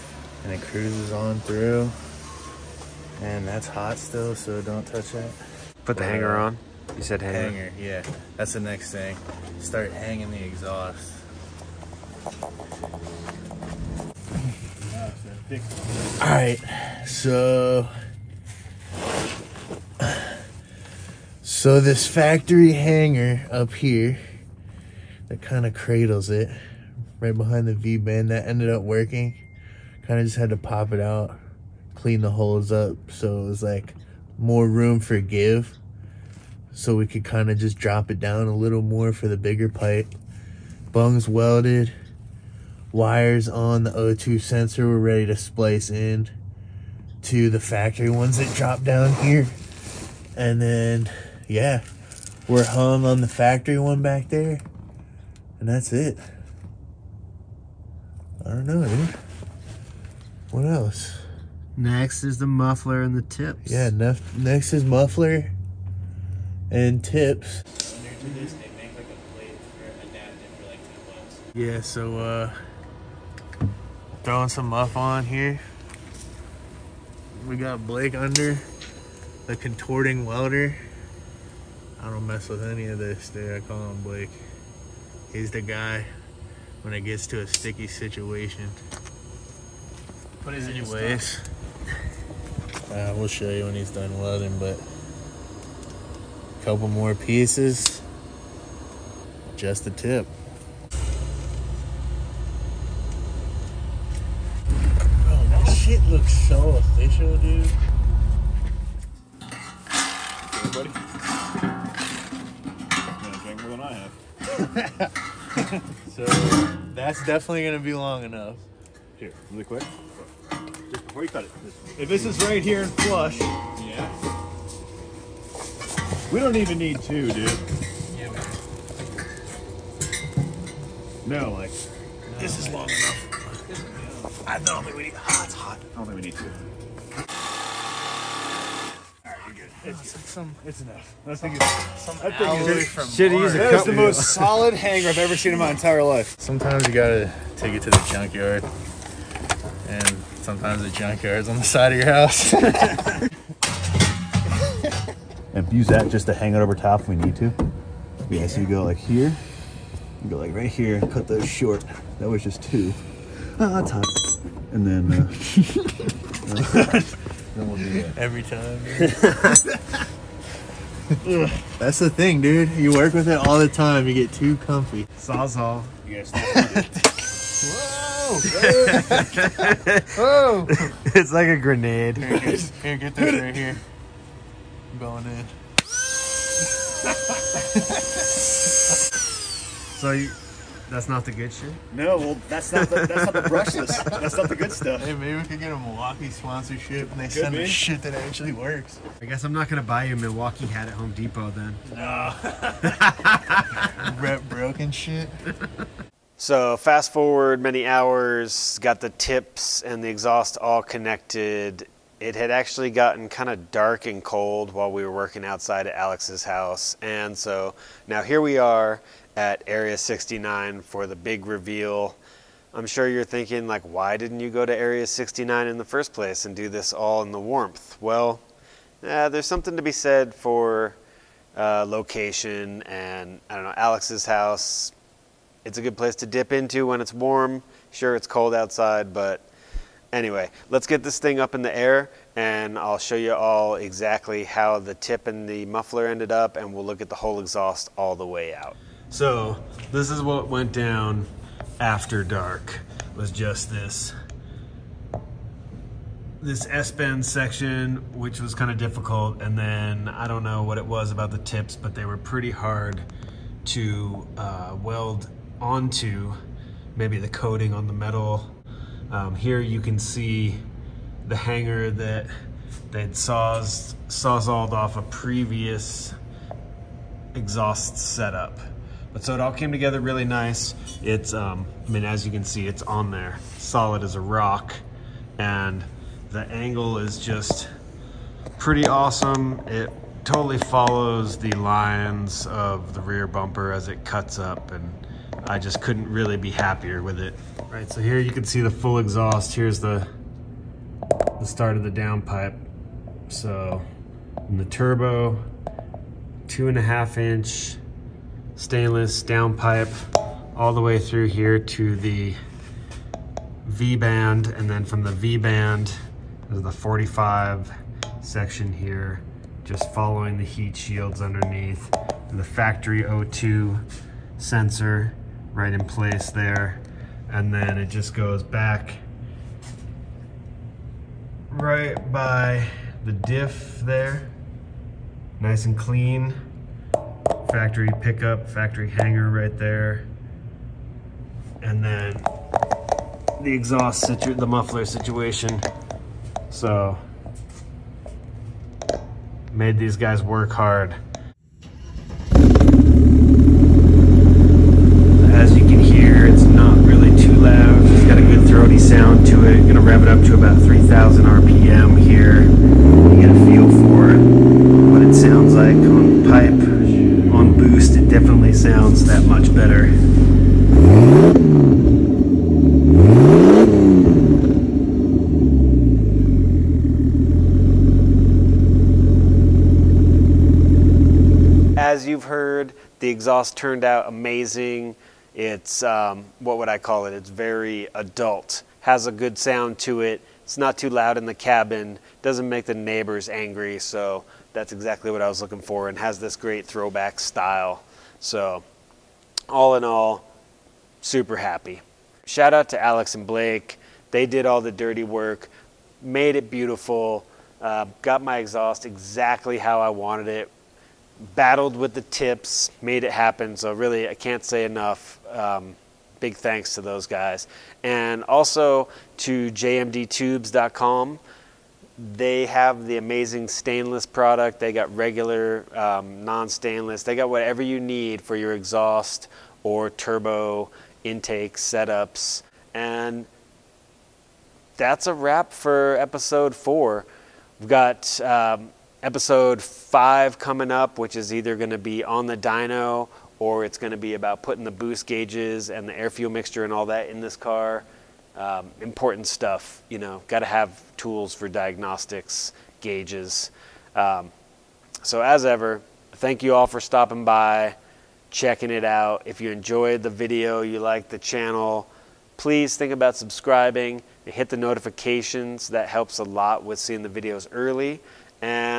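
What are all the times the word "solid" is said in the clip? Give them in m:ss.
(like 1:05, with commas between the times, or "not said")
2:24, 4:43.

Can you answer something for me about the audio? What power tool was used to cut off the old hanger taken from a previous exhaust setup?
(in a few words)
Sawzall.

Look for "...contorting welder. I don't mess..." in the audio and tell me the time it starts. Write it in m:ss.
1:19.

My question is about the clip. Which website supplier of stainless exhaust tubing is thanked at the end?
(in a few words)
jmdtubes.com.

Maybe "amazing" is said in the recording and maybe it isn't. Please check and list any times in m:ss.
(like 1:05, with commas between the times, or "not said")
6:24, 7:02.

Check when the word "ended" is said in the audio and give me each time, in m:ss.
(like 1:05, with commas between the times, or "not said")
0:28, 4:06.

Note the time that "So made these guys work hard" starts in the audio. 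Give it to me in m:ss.
5:46.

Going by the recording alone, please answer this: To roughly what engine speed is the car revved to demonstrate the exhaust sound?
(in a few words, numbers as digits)
3,000 RPM.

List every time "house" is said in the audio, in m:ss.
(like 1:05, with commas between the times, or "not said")
2:32, 3:36, 3:54.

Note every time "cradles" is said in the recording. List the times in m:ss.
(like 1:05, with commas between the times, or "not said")
0:25.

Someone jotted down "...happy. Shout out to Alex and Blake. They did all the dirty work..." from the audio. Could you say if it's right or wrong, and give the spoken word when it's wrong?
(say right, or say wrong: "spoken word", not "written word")
right.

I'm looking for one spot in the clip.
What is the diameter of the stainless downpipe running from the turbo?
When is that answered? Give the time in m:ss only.
5:06.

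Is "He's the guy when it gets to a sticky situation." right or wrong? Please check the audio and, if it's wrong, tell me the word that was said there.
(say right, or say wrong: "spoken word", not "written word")
right.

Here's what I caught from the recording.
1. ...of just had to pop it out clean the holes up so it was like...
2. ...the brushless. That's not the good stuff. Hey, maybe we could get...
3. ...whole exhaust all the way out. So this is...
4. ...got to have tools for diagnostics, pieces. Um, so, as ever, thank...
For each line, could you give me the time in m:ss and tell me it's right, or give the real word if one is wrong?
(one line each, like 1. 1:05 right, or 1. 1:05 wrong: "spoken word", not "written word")
1. 0:30 right
2. 3:13 right
3. 4:07 right
4. 7:30 wrong: "gauges", not "pieces".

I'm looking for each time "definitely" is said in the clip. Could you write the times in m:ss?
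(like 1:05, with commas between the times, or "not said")
1:57, 6:08.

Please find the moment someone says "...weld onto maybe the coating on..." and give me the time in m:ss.
4:24.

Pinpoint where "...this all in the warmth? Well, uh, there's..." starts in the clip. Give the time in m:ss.
3:46.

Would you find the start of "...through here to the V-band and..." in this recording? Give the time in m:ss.
5:10.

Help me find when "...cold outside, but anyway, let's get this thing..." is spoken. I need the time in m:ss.
3:58.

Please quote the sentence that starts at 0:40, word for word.
Bungs welded, wires on the O2 sensor were ready to splice in to the factory ones that drop down here.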